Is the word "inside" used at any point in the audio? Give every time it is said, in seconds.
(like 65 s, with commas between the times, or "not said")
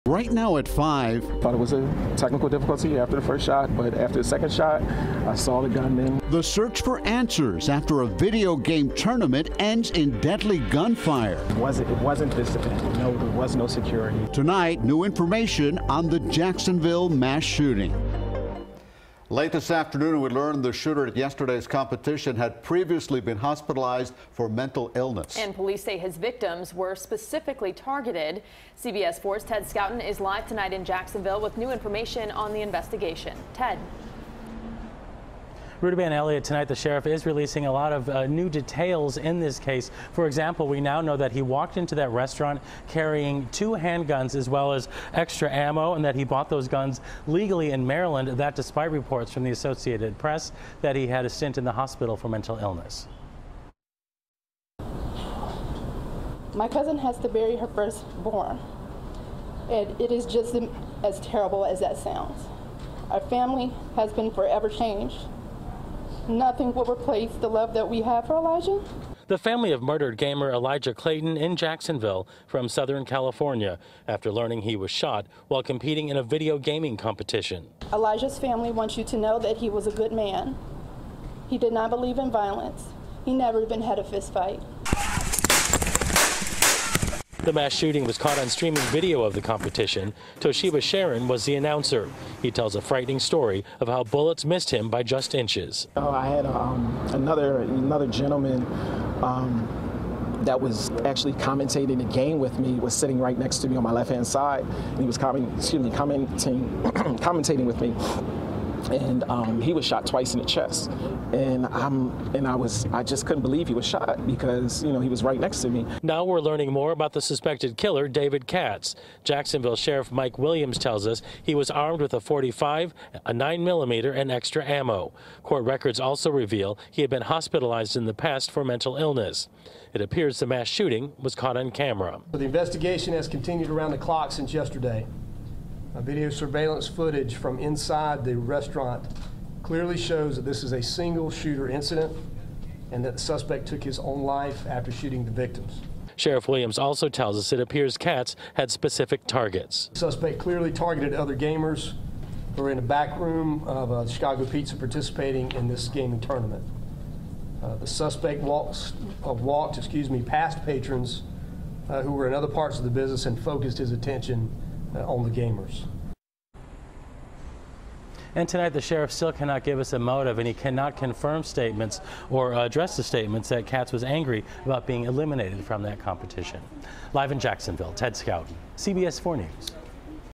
137 s.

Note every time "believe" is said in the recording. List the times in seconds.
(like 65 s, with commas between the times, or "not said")
81 s, 113 s.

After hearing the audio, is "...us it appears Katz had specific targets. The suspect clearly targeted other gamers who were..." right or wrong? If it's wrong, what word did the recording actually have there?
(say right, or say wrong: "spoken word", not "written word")
right.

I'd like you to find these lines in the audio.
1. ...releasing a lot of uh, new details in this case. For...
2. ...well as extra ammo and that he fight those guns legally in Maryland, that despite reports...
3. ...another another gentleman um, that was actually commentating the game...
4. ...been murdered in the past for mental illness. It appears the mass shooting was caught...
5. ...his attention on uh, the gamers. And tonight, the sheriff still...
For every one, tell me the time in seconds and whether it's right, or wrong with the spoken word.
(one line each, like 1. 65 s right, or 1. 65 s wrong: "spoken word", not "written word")
1. 37 s right
2. 44 s wrong: "bought", not "fight"
3. 97 s right
4. 127 s wrong: "hospitalized", not "murdered"
5. 163 s right.